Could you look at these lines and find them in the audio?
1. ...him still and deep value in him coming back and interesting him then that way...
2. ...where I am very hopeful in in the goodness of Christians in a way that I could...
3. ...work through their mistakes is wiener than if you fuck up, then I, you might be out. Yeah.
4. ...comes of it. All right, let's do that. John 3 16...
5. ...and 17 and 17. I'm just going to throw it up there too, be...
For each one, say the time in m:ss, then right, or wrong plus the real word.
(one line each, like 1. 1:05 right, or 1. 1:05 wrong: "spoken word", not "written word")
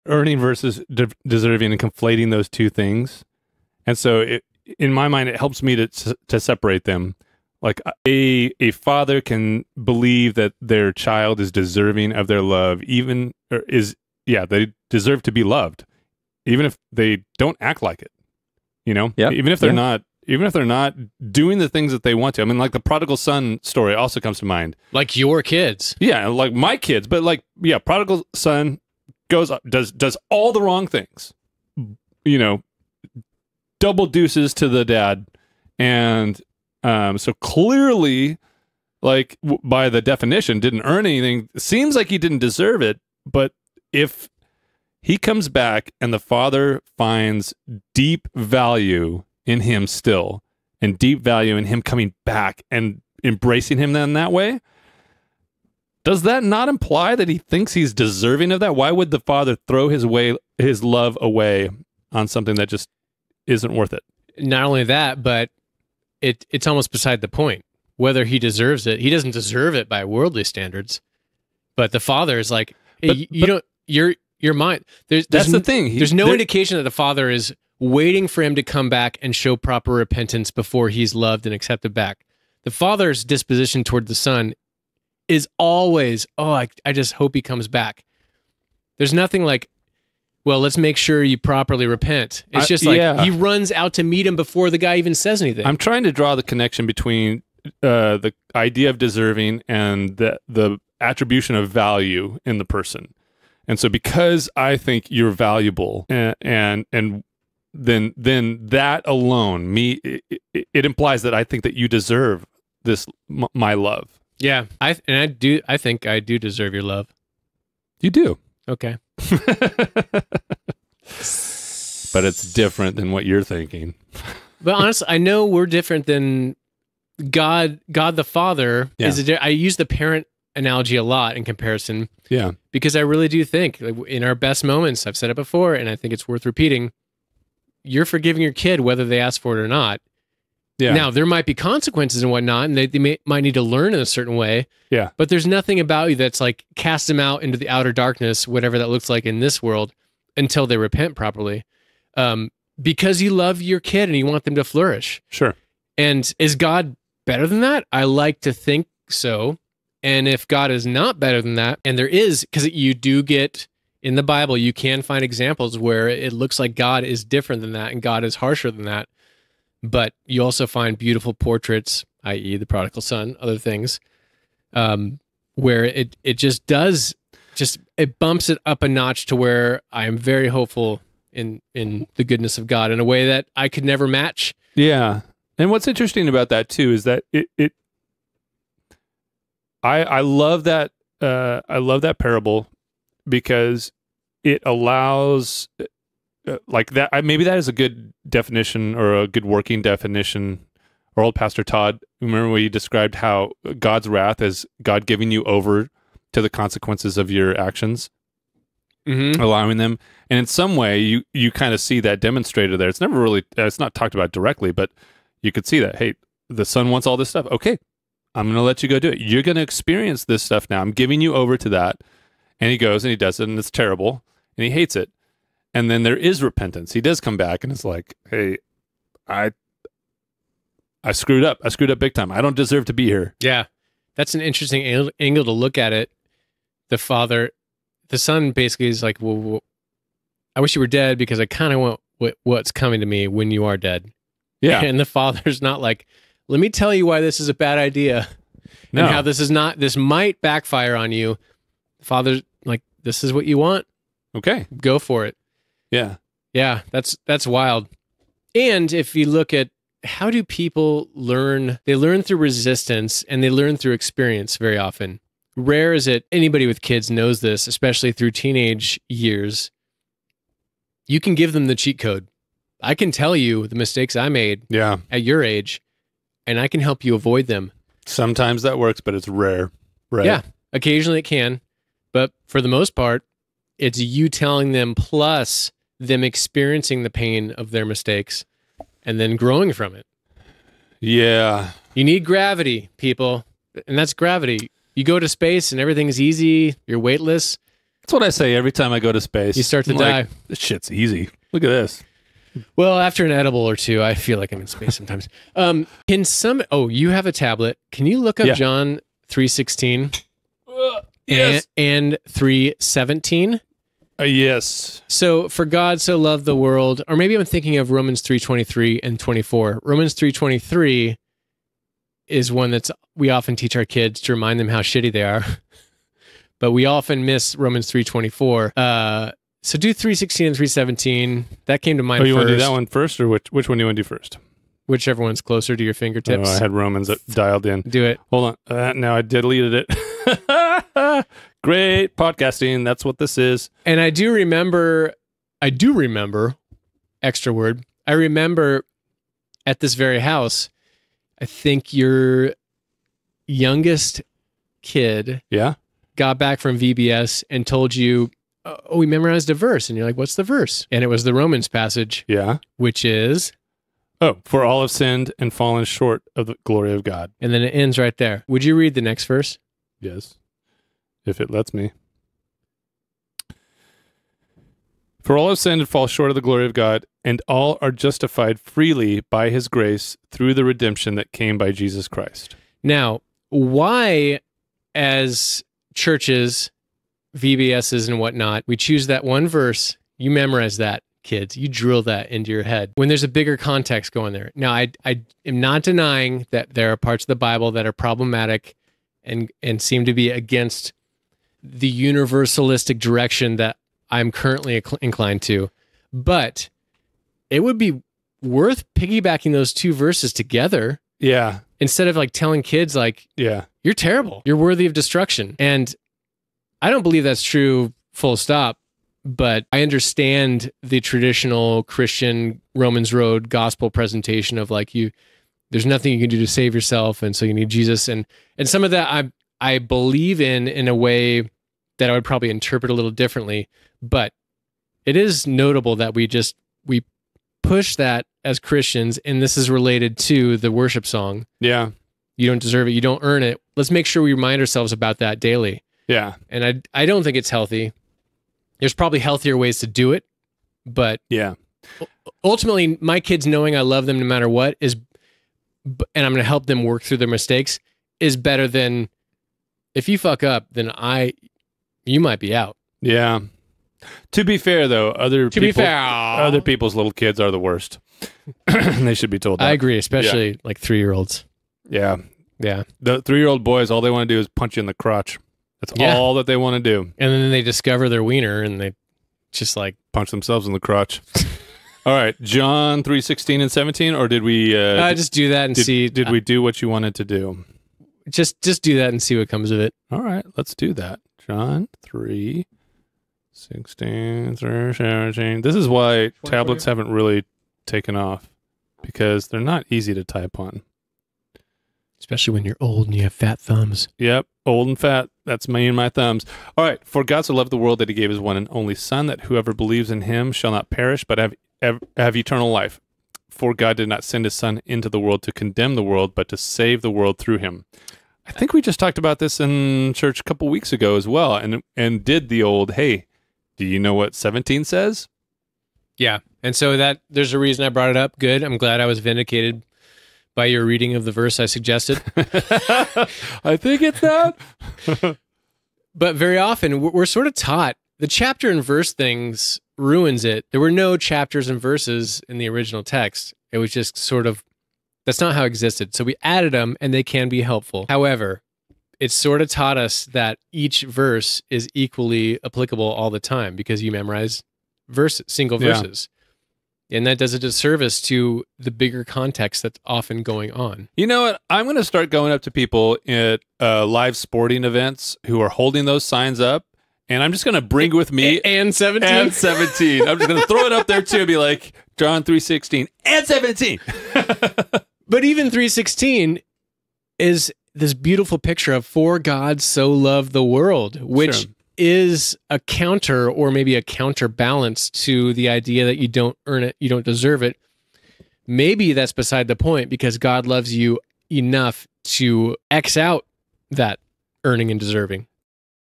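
1. 0:49 wrong: "embracing", not "interesting"
2. 2:59 wrong: "God", not "Christians"
3. 7:36 wrong: "better", not "wiener"
4. 8:09 right
5. 9:28 right.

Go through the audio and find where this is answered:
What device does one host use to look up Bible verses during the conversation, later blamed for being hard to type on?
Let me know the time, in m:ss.
5:07.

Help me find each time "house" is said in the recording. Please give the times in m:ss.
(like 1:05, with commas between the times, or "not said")
5:50.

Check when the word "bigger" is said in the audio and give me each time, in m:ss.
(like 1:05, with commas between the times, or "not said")
6:33, 9:18.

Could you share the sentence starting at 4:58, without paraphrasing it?
That's what I say every time I go to space.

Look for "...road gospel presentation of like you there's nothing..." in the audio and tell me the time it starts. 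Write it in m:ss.
7:03.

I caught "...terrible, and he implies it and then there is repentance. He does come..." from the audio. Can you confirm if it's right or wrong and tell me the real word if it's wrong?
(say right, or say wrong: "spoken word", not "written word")
wrong: "hates", not "implies".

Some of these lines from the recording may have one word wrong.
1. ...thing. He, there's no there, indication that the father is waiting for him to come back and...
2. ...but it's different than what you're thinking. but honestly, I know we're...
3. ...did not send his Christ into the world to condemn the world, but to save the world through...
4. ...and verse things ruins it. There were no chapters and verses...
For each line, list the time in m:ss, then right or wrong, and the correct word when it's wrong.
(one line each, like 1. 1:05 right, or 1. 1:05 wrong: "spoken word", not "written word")
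1. 1:15 right
2. 1:59 right
3. 8:33 wrong: "Son", not "Christ"
4. 8:58 right.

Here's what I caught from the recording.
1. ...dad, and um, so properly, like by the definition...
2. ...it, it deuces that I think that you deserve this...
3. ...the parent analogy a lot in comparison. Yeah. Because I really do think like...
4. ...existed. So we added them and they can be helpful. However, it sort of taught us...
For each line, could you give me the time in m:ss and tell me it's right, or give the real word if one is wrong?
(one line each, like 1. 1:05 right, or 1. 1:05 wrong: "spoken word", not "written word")
1. 0:34 wrong: "clearly", not "properly"
2. 1:50 wrong: "implies", not "deuces"
3. 2:09 right
4. 9:05 right.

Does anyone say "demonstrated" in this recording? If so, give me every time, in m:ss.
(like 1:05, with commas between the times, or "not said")
3:32.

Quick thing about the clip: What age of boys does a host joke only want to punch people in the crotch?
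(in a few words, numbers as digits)
3.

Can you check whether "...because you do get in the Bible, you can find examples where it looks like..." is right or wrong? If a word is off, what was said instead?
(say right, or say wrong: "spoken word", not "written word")
right.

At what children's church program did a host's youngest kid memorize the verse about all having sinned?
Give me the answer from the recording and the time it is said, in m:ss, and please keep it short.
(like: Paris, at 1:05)
VBS, at 5:56.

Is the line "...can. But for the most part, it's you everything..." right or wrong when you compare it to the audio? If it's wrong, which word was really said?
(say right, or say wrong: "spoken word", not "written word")
wrong: "telling", not "everything".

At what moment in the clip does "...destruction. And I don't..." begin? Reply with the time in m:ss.
6:54.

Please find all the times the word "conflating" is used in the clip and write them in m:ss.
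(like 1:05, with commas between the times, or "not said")
0:01.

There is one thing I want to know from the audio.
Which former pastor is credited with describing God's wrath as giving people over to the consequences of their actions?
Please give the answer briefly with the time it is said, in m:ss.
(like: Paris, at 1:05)
Pastor Todd, at 3:21.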